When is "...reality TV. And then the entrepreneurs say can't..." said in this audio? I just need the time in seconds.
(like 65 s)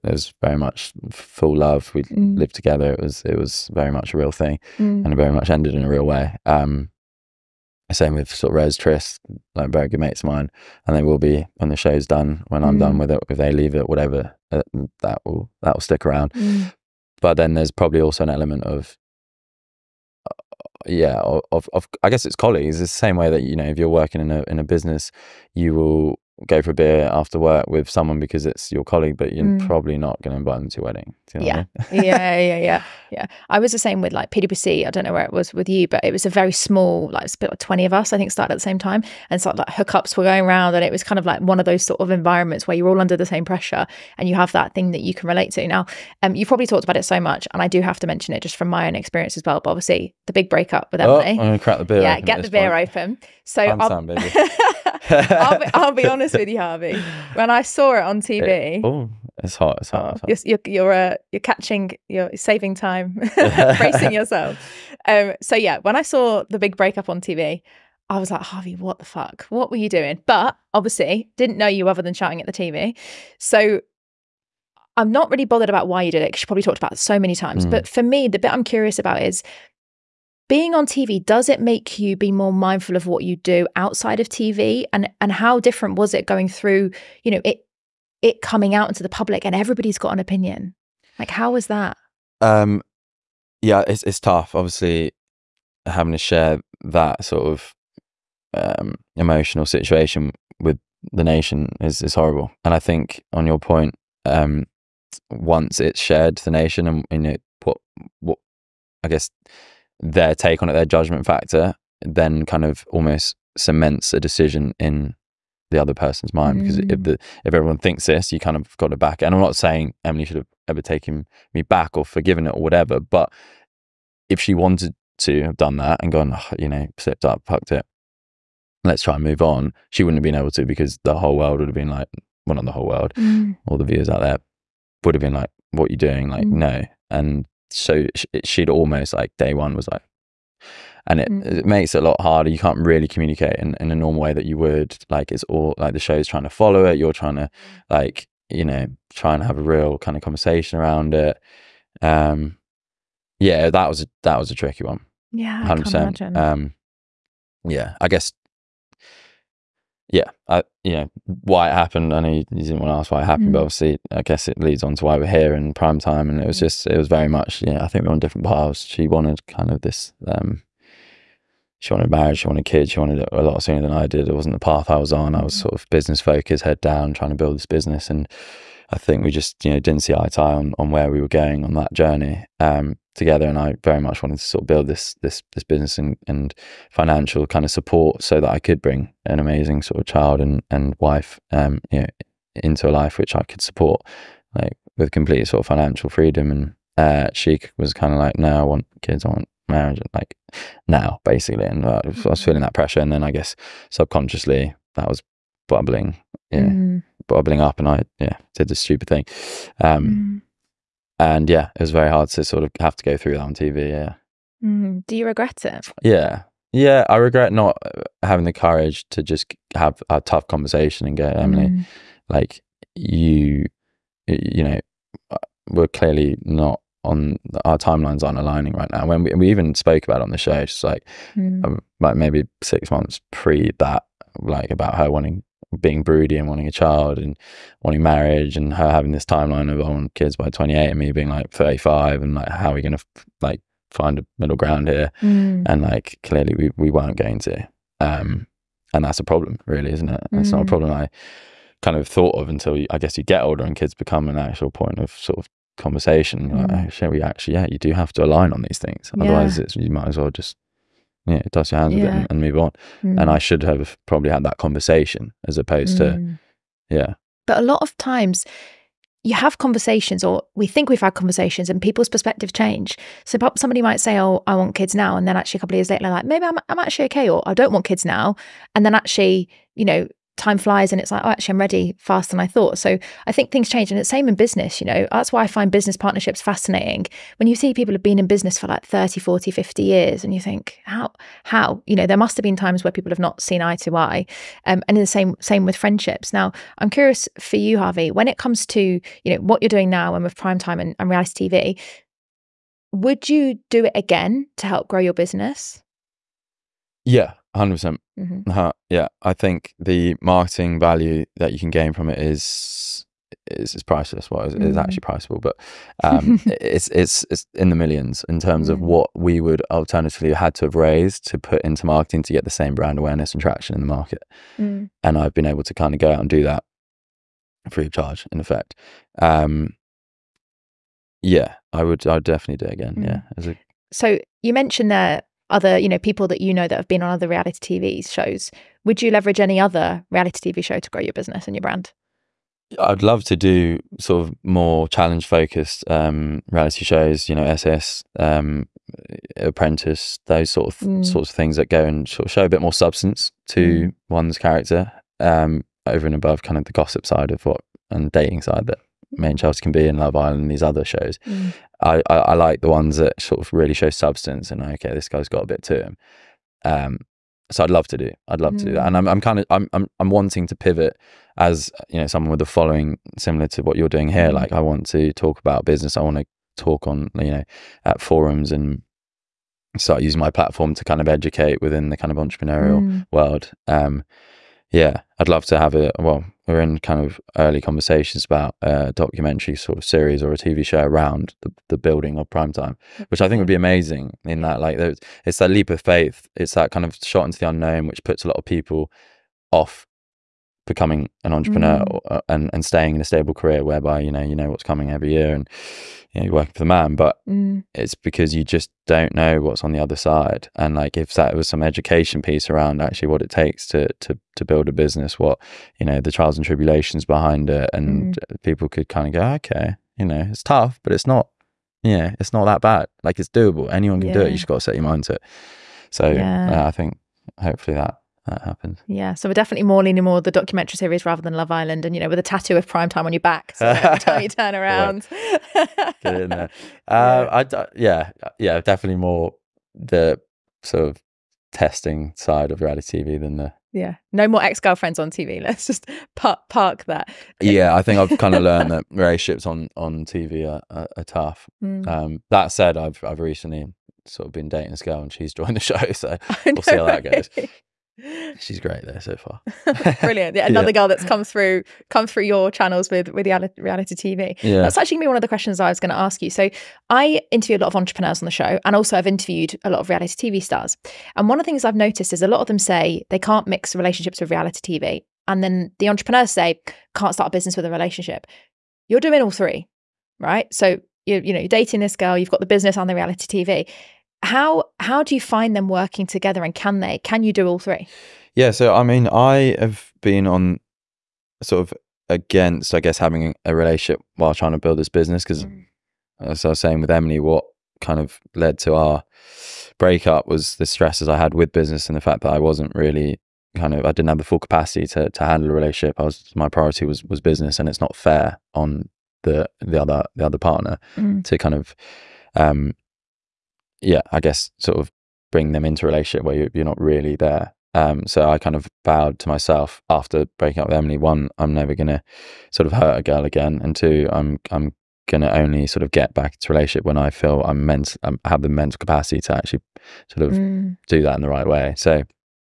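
474 s.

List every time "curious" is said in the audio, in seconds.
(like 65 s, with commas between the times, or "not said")
78 s, 296 s.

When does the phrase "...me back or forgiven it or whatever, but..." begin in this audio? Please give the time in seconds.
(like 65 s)
121 s.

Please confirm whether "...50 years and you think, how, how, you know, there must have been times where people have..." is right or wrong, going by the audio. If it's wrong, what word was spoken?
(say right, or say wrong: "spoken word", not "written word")
right.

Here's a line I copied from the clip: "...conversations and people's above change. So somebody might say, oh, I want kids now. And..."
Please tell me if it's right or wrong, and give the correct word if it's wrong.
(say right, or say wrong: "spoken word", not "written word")
wrong: "perspective", not "above".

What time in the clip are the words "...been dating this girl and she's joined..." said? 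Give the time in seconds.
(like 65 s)
454 s.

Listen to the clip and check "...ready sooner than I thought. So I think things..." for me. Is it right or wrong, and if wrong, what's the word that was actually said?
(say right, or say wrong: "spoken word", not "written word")
wrong: "faster", not "sooner".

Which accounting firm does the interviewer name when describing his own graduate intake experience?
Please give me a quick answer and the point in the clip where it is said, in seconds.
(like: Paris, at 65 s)
PwC, at 34 s.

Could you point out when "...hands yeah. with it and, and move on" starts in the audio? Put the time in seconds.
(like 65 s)
261 s.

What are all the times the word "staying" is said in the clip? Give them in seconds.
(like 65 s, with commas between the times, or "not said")
402 s.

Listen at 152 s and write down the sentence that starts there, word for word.
Um, yeah, that was a that was a tricky one.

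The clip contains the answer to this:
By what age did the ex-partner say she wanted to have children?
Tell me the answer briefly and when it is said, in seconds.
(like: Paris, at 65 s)
28, at 240 s.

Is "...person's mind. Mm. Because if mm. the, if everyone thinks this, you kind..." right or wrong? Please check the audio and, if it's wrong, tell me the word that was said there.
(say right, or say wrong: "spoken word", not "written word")
right.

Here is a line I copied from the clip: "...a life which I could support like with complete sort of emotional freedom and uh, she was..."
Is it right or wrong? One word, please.
wrong.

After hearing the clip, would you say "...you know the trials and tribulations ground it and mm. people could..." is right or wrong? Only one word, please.
wrong.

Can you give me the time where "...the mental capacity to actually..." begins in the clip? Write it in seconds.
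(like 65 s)
528 s.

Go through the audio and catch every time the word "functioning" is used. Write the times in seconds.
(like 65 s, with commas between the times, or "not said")
not said.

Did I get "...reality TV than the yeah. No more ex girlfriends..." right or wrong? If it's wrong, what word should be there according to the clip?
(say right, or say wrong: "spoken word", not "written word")
right.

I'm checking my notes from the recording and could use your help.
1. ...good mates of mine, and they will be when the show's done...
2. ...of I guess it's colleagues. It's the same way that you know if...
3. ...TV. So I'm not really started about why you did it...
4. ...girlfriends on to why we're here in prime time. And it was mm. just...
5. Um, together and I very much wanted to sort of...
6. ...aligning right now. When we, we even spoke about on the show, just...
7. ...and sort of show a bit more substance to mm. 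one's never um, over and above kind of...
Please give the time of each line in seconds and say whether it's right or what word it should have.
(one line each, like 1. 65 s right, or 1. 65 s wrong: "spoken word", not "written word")
1. 9 s right
2. 21 s right
3. 72 s wrong: "bothered", not "started"
4. 164 s wrong: "leads", not "girlfriends"
5. 182 s right
6. 228 s right
7. 351 s wrong: "character", not "never".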